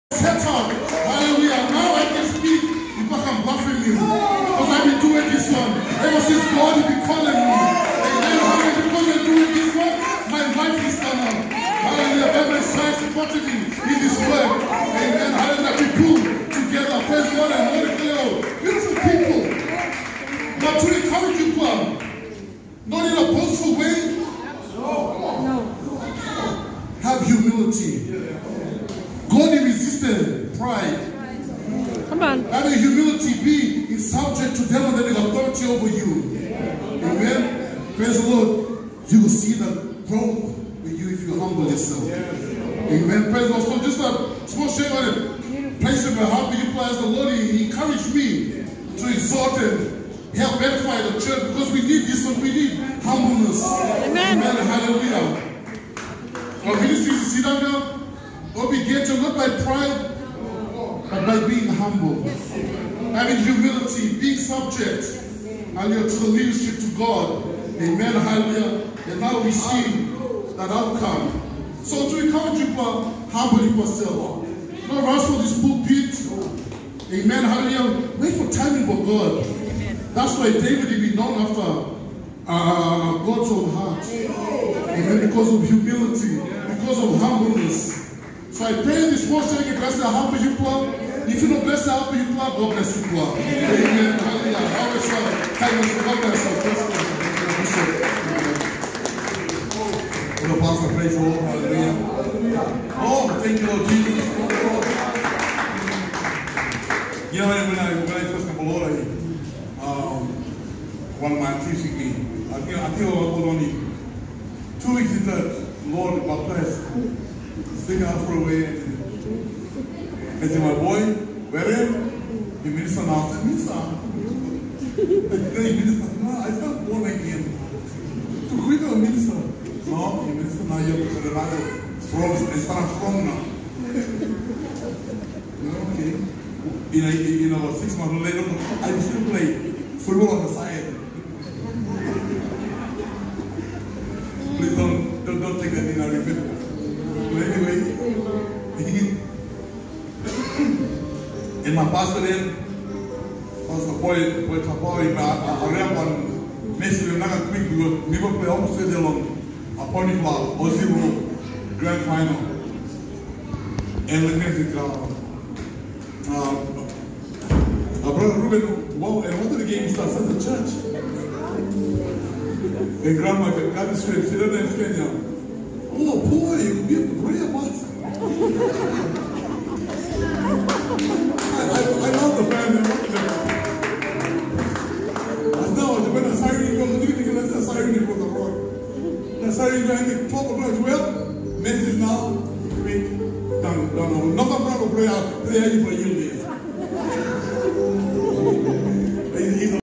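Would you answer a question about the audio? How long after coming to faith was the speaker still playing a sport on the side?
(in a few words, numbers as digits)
6 months.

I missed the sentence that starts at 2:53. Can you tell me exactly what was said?
And grandma, grandma straight, she doesn't understand you.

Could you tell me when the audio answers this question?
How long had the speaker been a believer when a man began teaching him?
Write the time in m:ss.
1:54.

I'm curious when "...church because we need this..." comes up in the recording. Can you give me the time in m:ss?
0:51.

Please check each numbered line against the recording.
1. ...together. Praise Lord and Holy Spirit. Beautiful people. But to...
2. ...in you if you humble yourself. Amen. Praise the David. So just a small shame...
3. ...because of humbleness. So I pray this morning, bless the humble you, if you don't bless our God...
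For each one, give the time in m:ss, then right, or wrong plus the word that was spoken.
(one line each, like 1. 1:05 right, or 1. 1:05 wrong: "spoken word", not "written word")
1. 0:16 wrong: "God", not "Lord"
2. 0:40 wrong: "Lord", not "David"
3. 1:26 right.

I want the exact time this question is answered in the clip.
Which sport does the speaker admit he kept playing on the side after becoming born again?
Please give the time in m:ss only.
2:20.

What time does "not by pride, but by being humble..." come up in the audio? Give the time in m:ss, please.
0:59.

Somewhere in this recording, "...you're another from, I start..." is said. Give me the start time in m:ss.
2:10.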